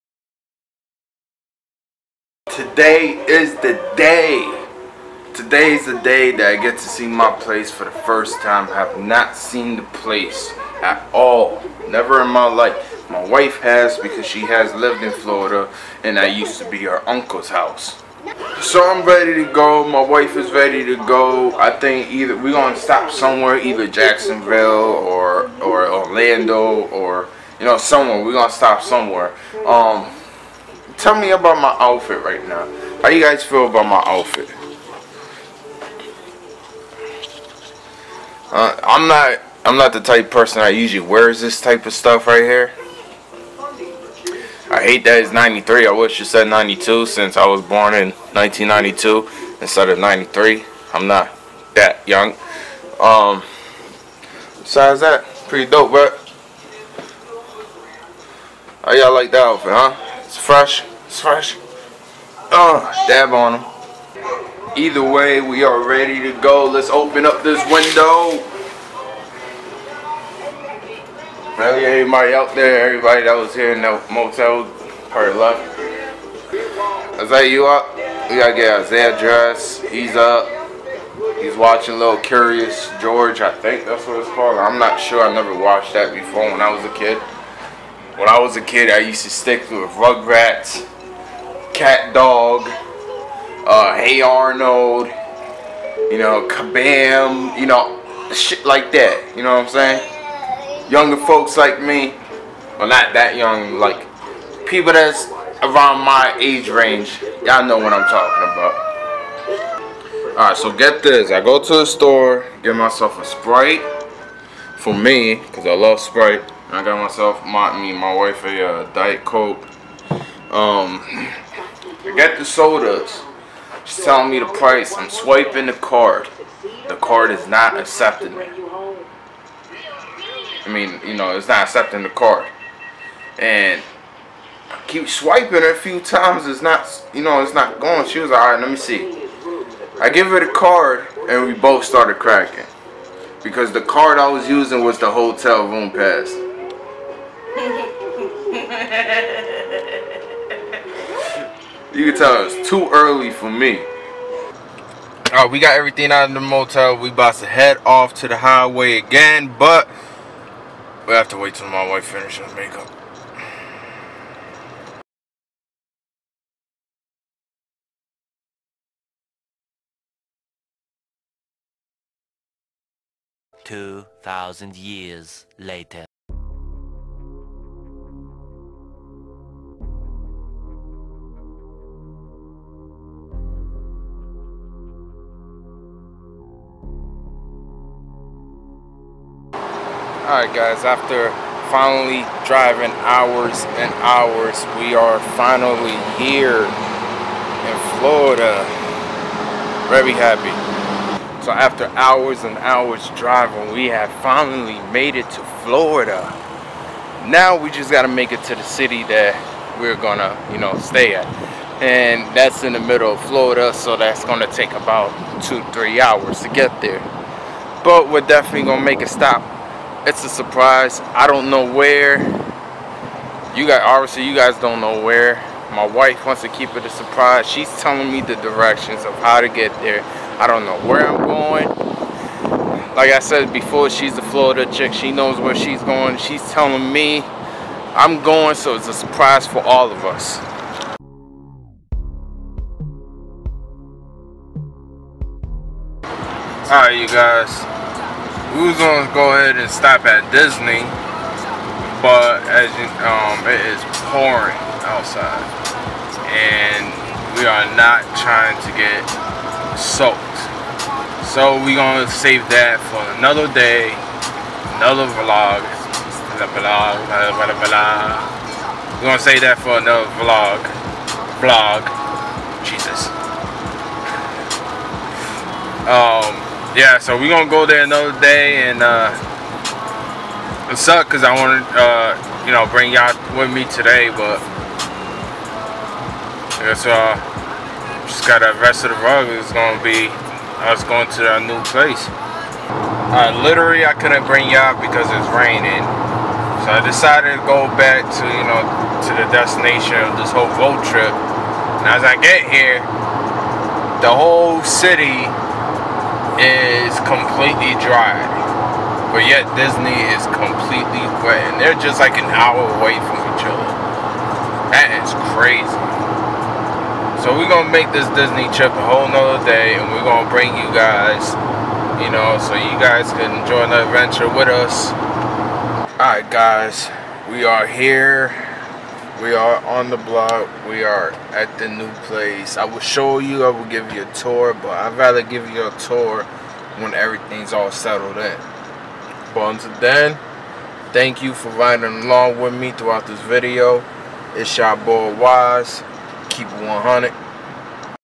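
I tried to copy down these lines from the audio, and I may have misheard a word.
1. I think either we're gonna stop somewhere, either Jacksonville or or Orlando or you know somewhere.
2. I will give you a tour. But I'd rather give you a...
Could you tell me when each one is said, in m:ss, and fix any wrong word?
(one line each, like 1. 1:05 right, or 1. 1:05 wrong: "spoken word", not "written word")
1. 0:21 right
2. 5:33 right.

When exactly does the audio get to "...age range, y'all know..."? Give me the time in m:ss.
1:46.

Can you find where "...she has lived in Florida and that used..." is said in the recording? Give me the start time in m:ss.
0:14.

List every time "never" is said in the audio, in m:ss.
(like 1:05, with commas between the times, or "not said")
0:11, 1:25.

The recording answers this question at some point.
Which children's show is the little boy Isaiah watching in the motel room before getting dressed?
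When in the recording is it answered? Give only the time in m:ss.
1:22.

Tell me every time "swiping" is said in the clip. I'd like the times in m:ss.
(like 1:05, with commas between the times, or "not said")
2:05, 2:15.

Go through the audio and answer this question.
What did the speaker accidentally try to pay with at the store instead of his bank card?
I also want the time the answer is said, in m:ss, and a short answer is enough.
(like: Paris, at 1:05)
The hotel room pass, at 2:25.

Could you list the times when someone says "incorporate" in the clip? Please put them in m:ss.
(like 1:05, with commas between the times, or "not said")
not said.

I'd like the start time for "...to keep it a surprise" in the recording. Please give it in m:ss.
3:46.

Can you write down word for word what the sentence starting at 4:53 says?
Uh, literally, I couldn't bring y'all because it's raining.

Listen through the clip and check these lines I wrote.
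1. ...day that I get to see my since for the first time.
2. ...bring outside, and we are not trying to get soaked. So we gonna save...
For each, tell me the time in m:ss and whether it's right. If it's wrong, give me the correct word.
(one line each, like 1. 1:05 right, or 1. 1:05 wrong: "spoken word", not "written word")
1. 0:05 wrong: "place", not "since"
2. 4:14 wrong: "pouring", not "bring".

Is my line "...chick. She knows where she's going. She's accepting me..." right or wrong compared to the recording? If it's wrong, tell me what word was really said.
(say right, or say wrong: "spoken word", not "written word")
wrong: "telling", not "accepting".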